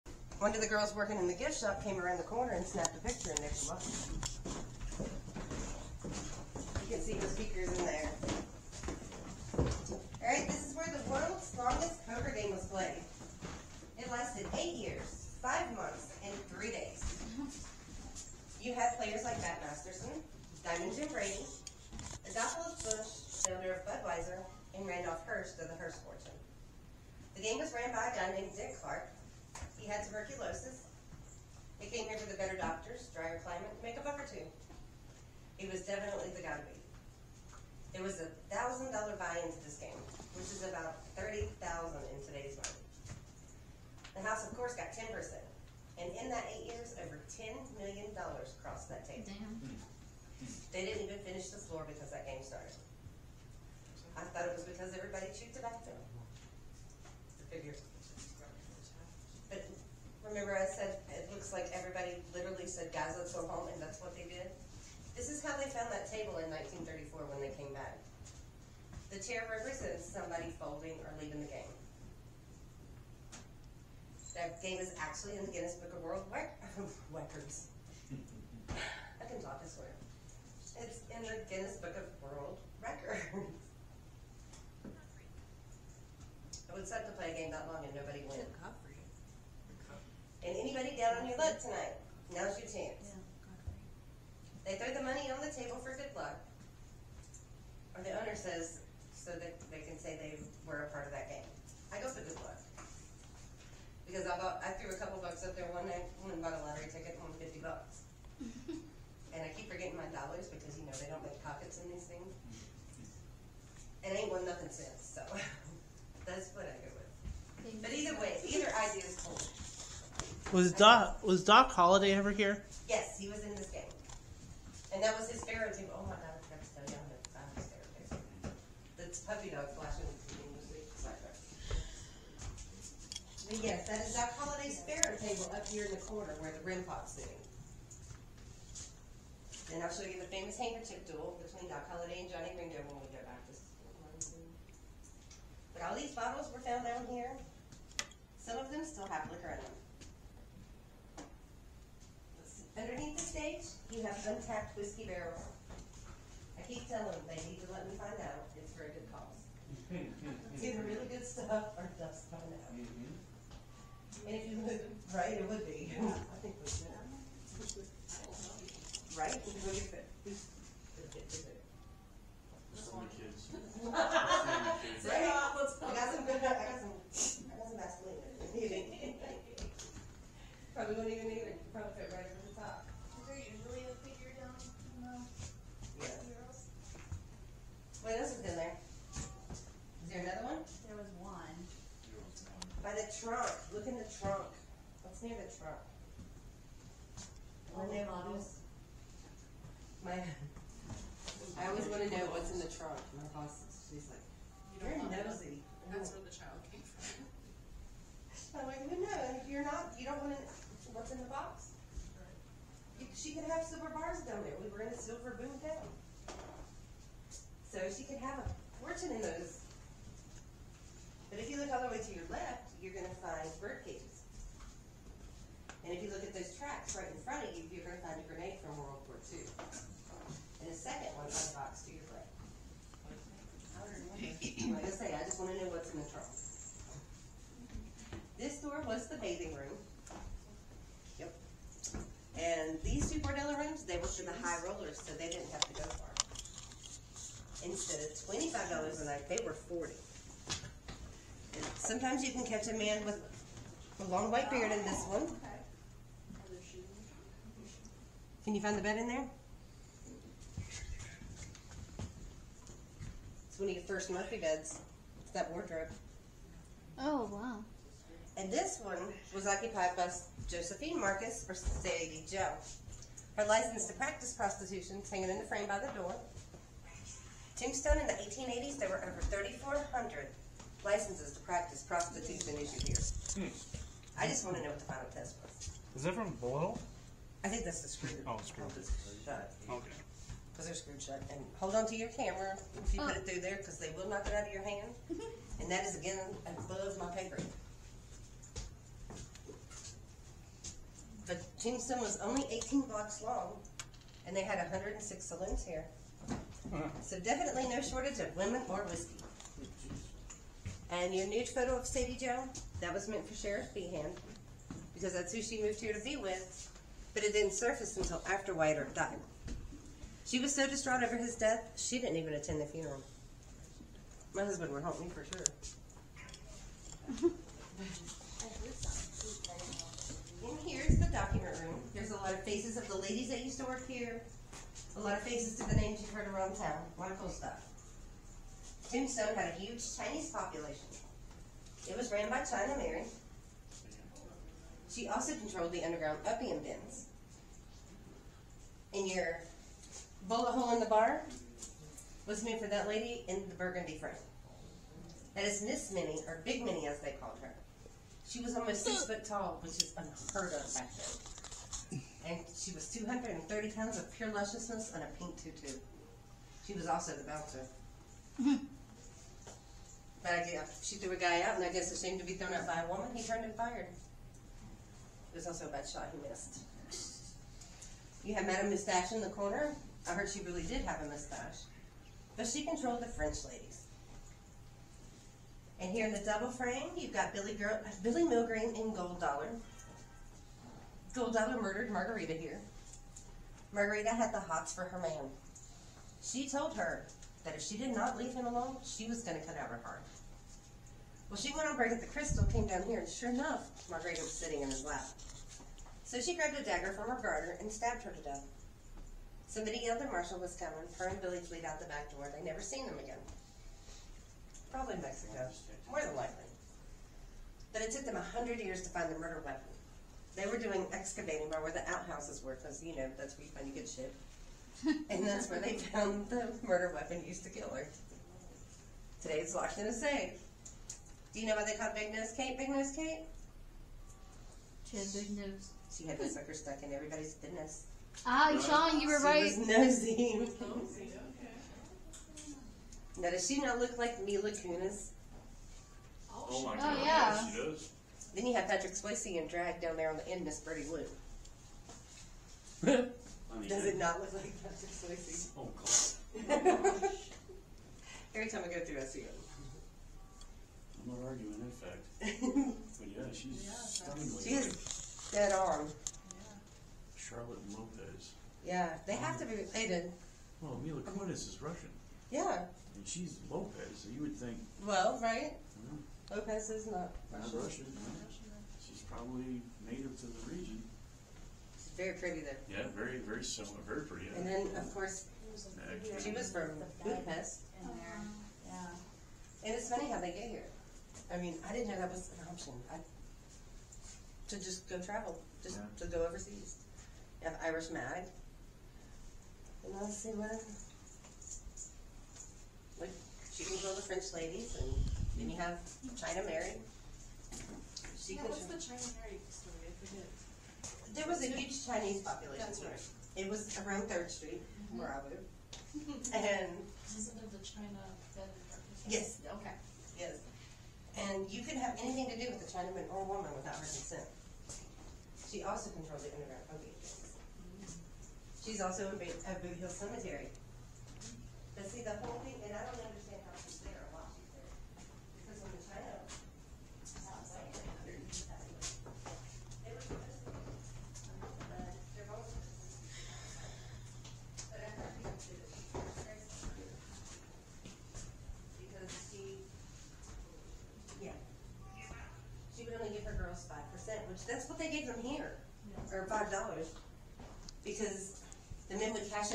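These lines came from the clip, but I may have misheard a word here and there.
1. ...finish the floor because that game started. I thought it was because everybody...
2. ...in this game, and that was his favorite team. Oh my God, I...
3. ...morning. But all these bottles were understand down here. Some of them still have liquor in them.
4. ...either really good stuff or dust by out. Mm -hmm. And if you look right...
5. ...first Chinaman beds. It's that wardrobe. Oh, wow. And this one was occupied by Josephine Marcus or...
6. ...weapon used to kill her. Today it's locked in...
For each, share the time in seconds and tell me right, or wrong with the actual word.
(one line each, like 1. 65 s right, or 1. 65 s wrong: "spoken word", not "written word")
1. 51 s right
2. 123 s right
3. 143 s wrong: "found", not "understand"
4. 160 s right
5. 263 s wrong: "Murphy", not "Chinaman"
6. 426 s right.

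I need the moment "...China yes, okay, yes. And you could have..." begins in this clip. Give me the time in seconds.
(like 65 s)
517 s.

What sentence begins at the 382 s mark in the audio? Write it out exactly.
But she controlled the French ladies.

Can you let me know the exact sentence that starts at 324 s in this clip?
My husband would help me for sure.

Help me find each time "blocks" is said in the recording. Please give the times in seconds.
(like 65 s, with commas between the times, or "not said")
302 s.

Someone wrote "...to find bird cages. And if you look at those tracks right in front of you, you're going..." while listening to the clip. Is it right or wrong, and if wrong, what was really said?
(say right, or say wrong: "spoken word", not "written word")
right.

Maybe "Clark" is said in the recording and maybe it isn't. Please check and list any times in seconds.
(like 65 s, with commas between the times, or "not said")
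28 s.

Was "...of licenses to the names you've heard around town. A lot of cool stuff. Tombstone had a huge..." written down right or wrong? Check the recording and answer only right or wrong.
wrong.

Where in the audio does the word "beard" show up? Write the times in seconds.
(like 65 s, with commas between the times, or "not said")
254 s.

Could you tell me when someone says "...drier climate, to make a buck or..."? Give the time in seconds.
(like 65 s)
33 s.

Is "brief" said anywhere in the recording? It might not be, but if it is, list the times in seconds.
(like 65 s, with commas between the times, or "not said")
not said.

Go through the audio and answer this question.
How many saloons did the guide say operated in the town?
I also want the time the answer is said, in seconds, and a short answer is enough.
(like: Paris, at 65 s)
106, at 304 s.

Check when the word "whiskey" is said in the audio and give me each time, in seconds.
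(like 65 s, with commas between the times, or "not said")
154 s, 308 s.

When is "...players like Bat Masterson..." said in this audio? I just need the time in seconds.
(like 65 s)
18 s.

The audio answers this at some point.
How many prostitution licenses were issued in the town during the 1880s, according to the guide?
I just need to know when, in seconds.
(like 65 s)
279 s.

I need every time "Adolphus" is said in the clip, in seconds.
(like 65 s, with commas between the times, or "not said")
22 s.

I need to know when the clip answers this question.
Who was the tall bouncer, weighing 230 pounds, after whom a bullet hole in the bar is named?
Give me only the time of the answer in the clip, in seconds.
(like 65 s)
356 s.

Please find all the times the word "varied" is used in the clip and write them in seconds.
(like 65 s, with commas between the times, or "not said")
not said.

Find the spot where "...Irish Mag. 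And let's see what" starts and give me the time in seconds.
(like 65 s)
497 s.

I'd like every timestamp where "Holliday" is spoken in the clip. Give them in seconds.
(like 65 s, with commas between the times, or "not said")
121 s, 134 s, 141 s.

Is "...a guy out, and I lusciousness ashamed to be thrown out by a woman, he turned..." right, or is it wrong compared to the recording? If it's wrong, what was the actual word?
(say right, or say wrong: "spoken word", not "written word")
wrong: "guess", not "lusciousness".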